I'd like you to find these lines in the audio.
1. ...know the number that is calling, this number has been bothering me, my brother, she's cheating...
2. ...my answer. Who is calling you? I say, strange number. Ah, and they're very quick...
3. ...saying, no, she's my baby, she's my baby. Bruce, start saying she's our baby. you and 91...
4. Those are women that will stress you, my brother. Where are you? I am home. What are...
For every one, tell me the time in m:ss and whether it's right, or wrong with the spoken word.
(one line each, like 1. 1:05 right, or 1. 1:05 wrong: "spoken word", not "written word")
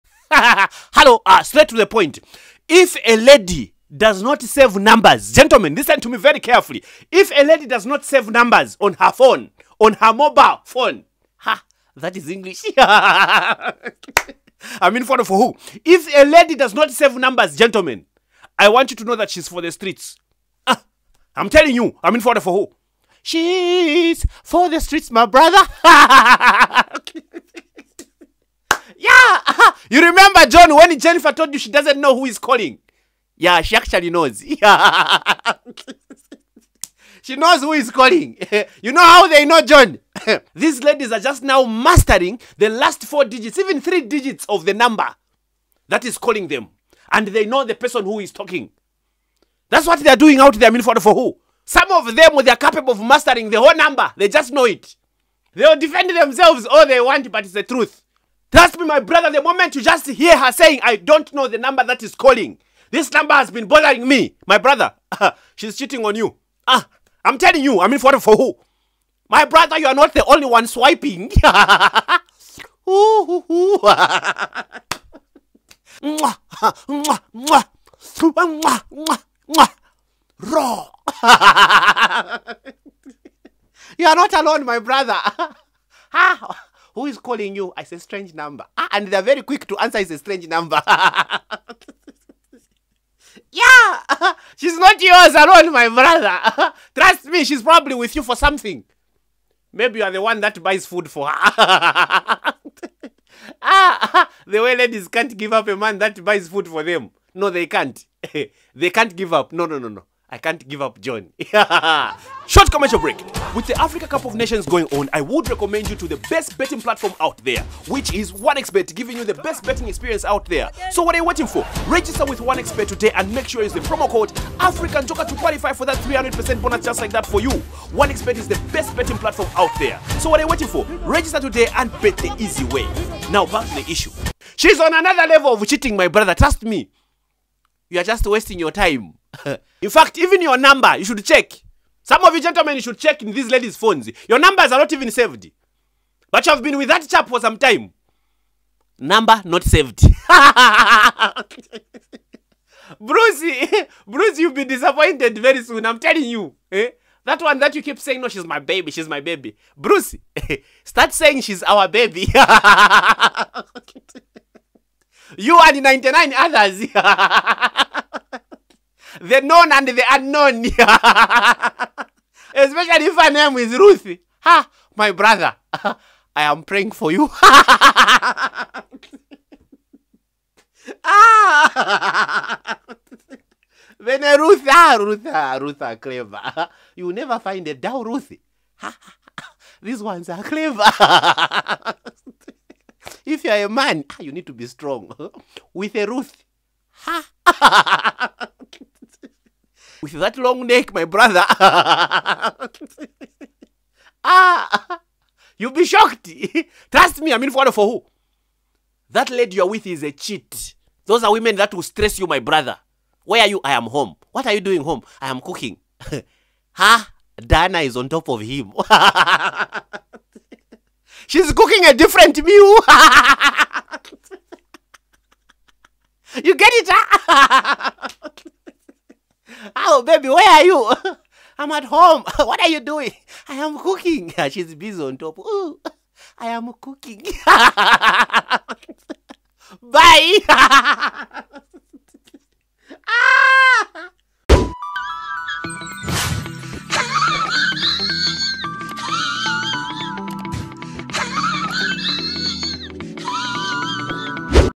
1. 1:01 right
2. 1:24 wrong: "brother", not "answer"
3. 2:37 wrong: "99", not "91"
4. 3:31 right.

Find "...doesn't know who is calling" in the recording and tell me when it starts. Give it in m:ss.
0:31.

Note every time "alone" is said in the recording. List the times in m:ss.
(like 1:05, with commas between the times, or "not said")
1:24, 1:35.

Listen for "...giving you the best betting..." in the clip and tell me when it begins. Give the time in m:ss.
1:58.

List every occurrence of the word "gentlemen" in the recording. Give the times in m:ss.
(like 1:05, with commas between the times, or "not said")
0:05, 0:17, 2:22.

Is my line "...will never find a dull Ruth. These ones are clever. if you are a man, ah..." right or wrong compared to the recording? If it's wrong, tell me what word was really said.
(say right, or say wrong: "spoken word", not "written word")
right.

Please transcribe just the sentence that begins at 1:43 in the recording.
ah, the way ladies can't give up a man that buys food for them.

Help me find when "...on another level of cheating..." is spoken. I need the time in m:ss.
2:14.